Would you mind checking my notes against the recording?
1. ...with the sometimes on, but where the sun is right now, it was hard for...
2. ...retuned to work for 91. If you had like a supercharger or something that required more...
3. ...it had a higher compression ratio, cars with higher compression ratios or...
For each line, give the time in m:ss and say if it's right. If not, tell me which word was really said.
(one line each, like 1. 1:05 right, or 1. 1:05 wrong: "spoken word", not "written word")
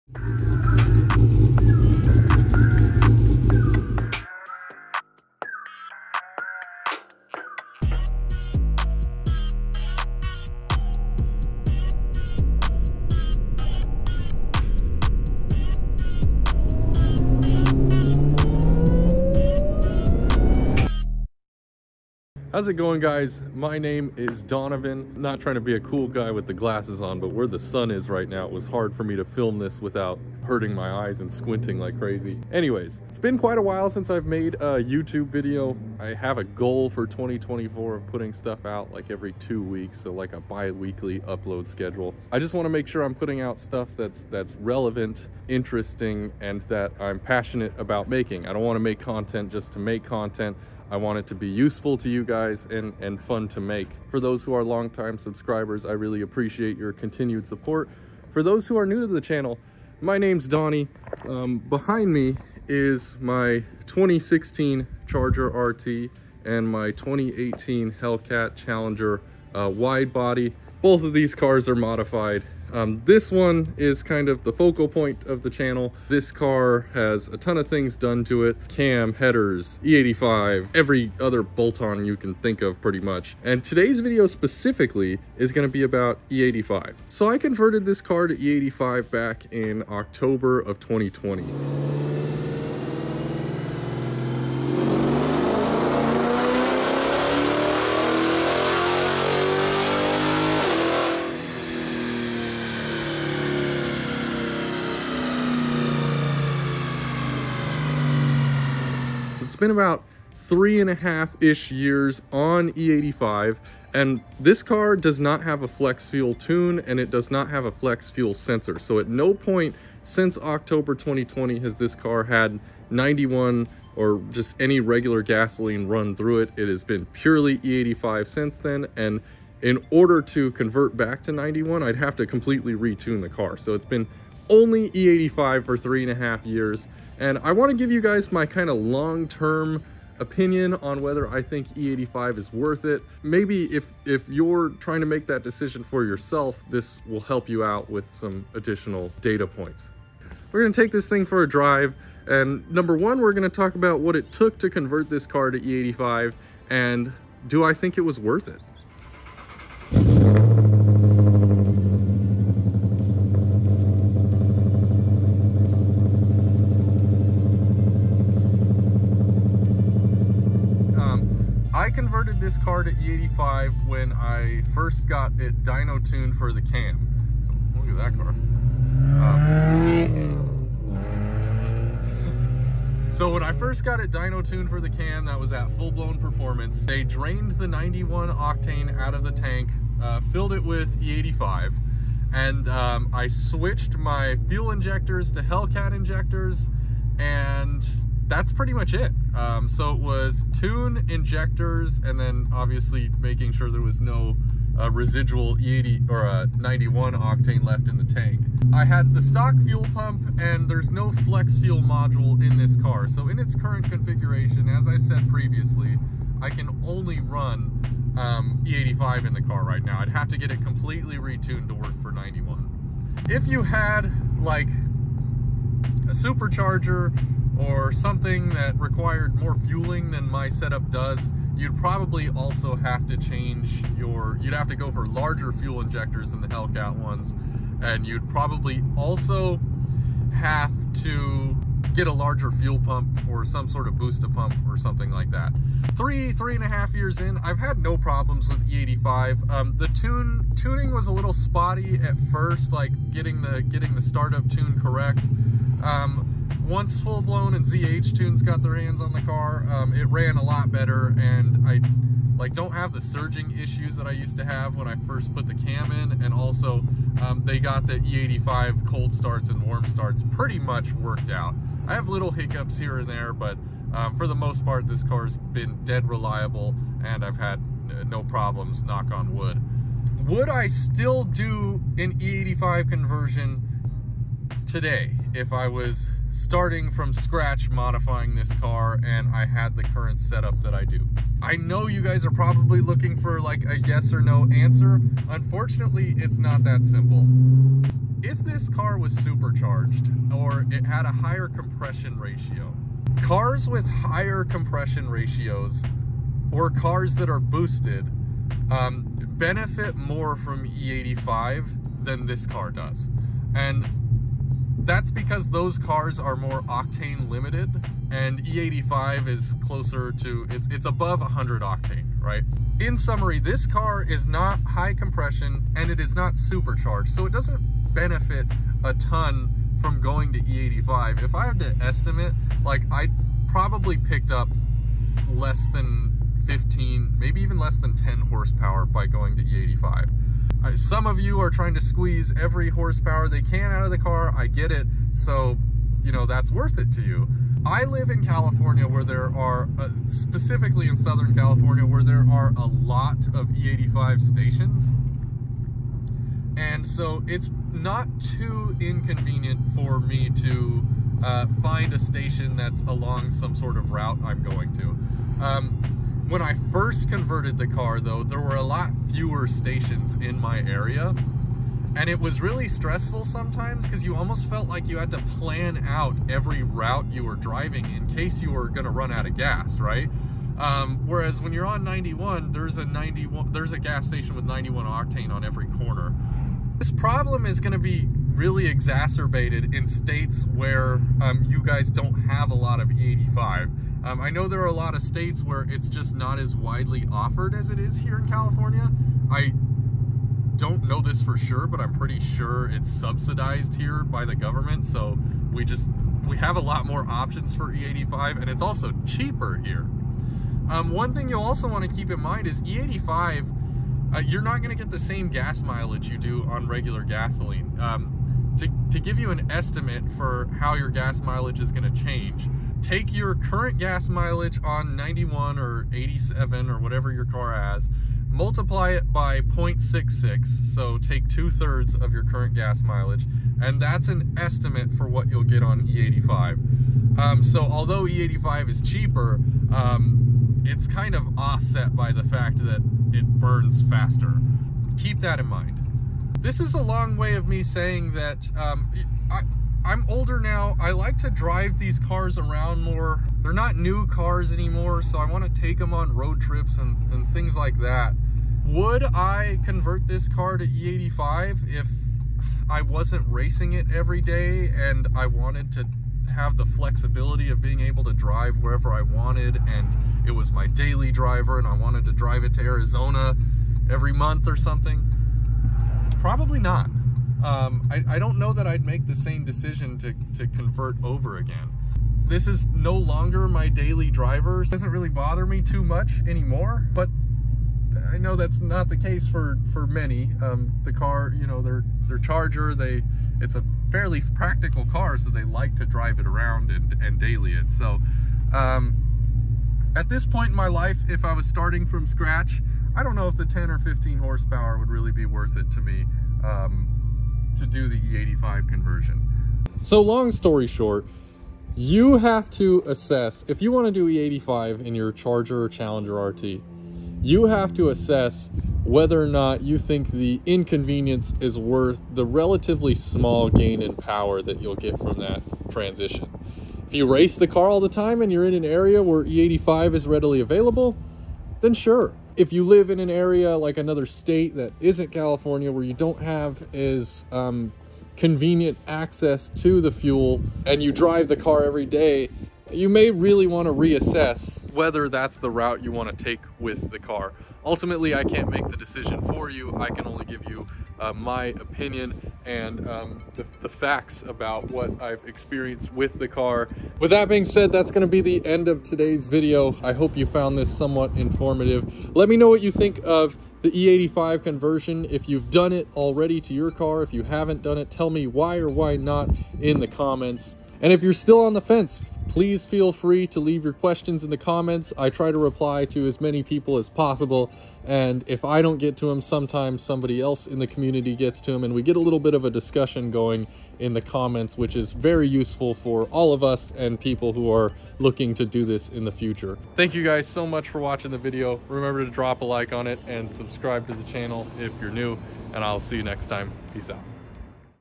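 1. 0:26 wrong: "glasses", not "sometimes"
2. 3:41 right
3. 5:00 right.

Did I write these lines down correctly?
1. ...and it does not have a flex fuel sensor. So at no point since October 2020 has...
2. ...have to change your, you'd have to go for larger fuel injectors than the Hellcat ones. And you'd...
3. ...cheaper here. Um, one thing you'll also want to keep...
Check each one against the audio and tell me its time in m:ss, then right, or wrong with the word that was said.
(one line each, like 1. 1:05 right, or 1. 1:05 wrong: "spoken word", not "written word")
1. 1:56 right
2. 3:52 right
3. 6:49 right.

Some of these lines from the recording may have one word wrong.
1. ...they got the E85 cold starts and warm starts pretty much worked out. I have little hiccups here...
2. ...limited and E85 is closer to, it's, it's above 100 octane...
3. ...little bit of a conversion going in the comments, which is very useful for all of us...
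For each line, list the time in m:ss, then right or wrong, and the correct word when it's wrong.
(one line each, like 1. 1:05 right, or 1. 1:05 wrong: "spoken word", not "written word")
1. 4:27 right
2. 5:17 right
3. 9:41 wrong: "discussion", not "conversion".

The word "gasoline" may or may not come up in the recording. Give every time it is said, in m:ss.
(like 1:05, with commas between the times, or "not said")
2:05, 6:57.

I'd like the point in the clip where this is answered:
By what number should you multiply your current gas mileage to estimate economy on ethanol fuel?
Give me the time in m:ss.
7:09.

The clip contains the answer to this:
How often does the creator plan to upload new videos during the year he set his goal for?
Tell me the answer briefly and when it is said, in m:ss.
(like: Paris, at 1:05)
every two weeks, at 0:39.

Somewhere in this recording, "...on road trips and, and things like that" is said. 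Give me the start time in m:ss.
7:35.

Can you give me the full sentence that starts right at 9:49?
Thank you guys so much for watching the video.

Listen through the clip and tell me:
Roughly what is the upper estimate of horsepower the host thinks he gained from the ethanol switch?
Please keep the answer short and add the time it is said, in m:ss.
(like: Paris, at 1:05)
15 horsepower, at 5:35.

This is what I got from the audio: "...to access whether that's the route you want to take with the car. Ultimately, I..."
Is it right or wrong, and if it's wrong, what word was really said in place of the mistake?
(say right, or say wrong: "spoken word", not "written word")
wrong: "reassess", not "access".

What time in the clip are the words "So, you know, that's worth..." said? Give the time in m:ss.
5:45.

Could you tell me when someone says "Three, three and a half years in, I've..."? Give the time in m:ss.
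4:05.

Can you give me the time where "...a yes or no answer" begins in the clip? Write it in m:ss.
4:53.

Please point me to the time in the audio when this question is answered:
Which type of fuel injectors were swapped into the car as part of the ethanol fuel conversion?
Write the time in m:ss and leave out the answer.
3:15.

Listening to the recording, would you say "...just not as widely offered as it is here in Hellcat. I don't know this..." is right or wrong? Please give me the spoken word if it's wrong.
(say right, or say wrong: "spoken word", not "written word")
wrong: "California", not "Hellcat".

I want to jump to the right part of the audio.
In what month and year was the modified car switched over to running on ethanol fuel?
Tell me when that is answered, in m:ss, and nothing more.
1:29.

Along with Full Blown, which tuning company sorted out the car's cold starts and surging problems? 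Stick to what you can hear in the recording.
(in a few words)
ZH tunes.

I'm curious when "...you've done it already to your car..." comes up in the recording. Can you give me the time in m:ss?
9:25.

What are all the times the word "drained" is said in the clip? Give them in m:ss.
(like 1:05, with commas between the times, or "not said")
3:07.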